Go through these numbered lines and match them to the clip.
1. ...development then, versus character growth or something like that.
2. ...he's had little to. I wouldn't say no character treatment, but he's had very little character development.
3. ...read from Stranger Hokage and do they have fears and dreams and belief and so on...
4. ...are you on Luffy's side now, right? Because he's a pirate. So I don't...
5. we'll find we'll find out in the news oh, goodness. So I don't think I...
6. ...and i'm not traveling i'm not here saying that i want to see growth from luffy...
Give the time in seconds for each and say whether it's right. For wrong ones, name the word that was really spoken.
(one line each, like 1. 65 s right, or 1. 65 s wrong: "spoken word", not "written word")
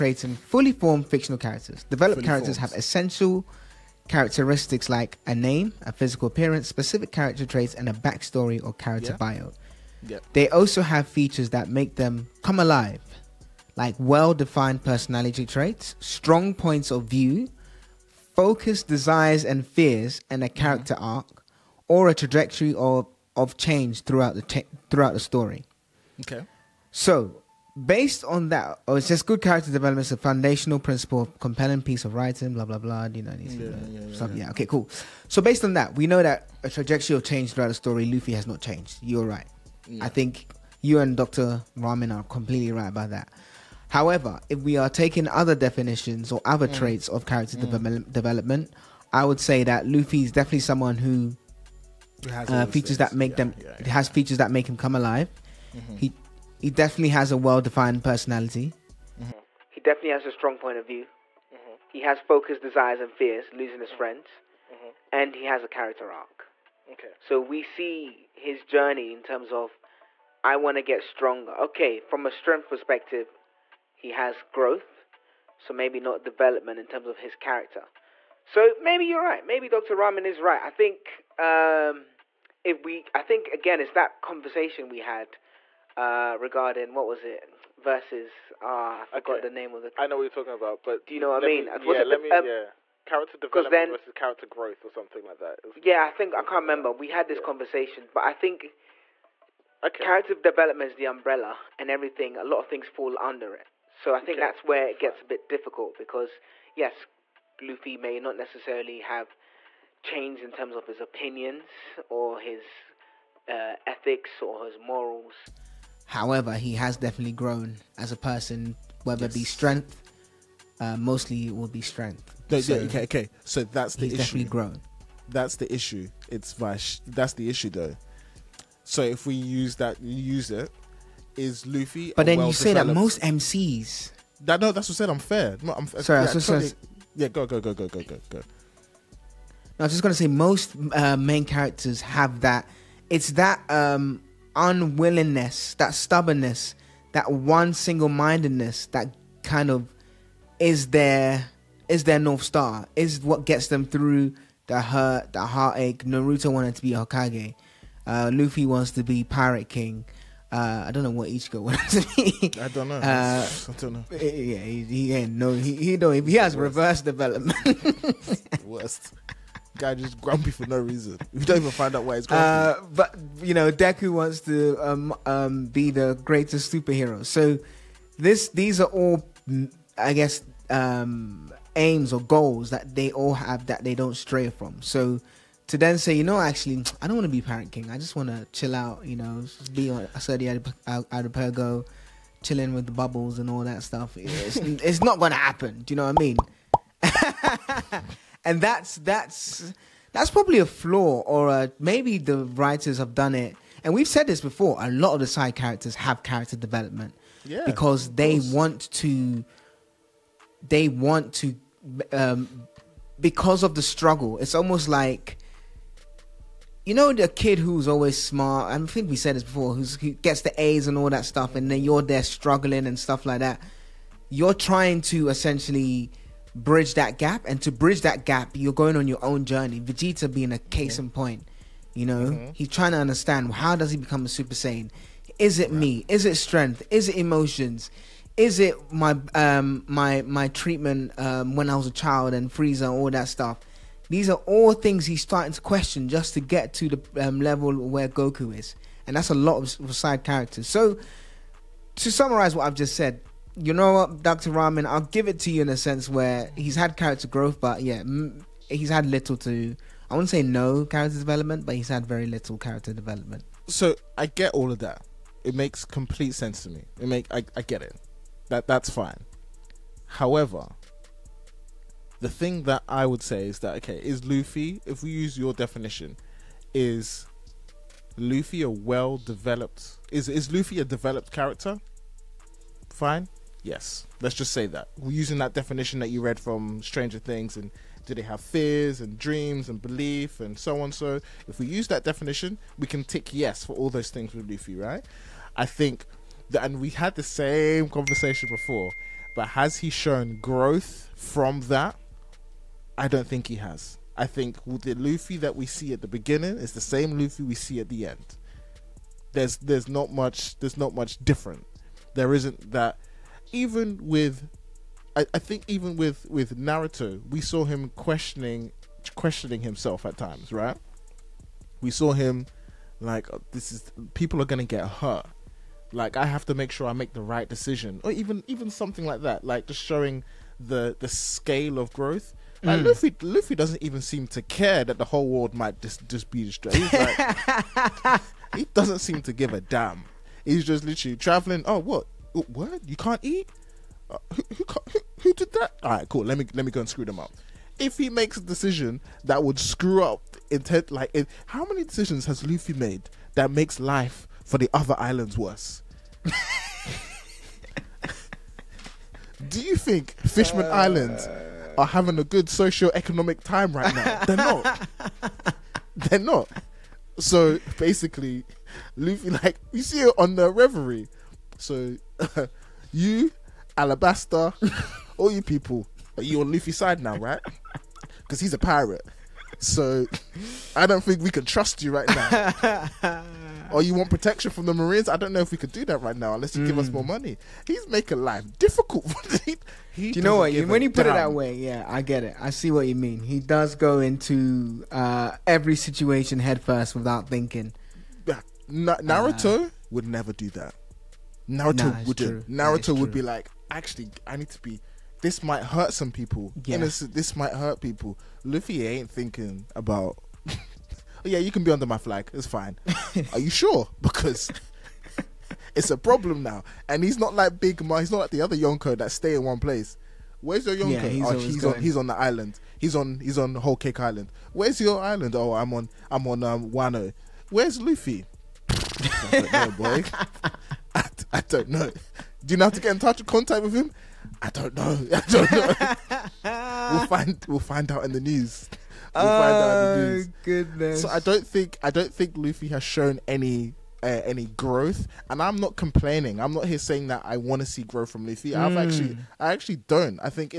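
1. 93 s right
2. 258 s wrong: "development", not "treatment"
3. 286 s wrong: "Things", not "Hokage"
4. 376 s right
5. 436 s right
6. 445 s wrong: "complaining", not "traveling".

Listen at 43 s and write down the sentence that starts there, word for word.
However, if we are taking other definitions or other mm.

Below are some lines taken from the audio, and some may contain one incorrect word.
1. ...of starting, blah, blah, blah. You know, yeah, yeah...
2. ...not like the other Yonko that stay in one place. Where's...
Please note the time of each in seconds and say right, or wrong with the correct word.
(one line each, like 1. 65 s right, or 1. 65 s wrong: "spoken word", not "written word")
1. 32 s wrong: "writing", not "starting"
2. 418 s right.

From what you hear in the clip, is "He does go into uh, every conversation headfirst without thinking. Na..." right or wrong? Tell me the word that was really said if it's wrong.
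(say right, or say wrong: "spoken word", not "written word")
wrong: "situation", not "conversation".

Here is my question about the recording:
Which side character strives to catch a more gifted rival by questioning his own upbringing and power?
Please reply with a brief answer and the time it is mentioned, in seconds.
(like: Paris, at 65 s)
Vegeta, at 229 s.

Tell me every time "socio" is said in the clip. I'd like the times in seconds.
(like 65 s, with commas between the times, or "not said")
362 s.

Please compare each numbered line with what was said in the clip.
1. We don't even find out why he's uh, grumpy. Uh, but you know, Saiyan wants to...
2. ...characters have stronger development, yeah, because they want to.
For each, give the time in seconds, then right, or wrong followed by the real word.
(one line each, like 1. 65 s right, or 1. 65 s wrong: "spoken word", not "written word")
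1. 171 s wrong: "Deku", not "Saiyan"
2. 205 s wrong: "character", not "stronger".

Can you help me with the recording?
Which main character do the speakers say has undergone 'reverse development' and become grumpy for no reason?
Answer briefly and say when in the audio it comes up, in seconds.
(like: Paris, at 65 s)
Ichigo, at 161 s.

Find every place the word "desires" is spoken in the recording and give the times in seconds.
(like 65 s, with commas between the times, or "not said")
18 s, 62 s.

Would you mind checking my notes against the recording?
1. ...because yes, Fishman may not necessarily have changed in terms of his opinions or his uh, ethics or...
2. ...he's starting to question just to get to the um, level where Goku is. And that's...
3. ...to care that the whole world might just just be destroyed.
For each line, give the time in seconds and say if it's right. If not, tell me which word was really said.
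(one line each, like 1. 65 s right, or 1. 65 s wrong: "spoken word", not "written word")
1. 105 s wrong: "Luffy", not "Fishman"
2. 245 s right
3. 334 s right.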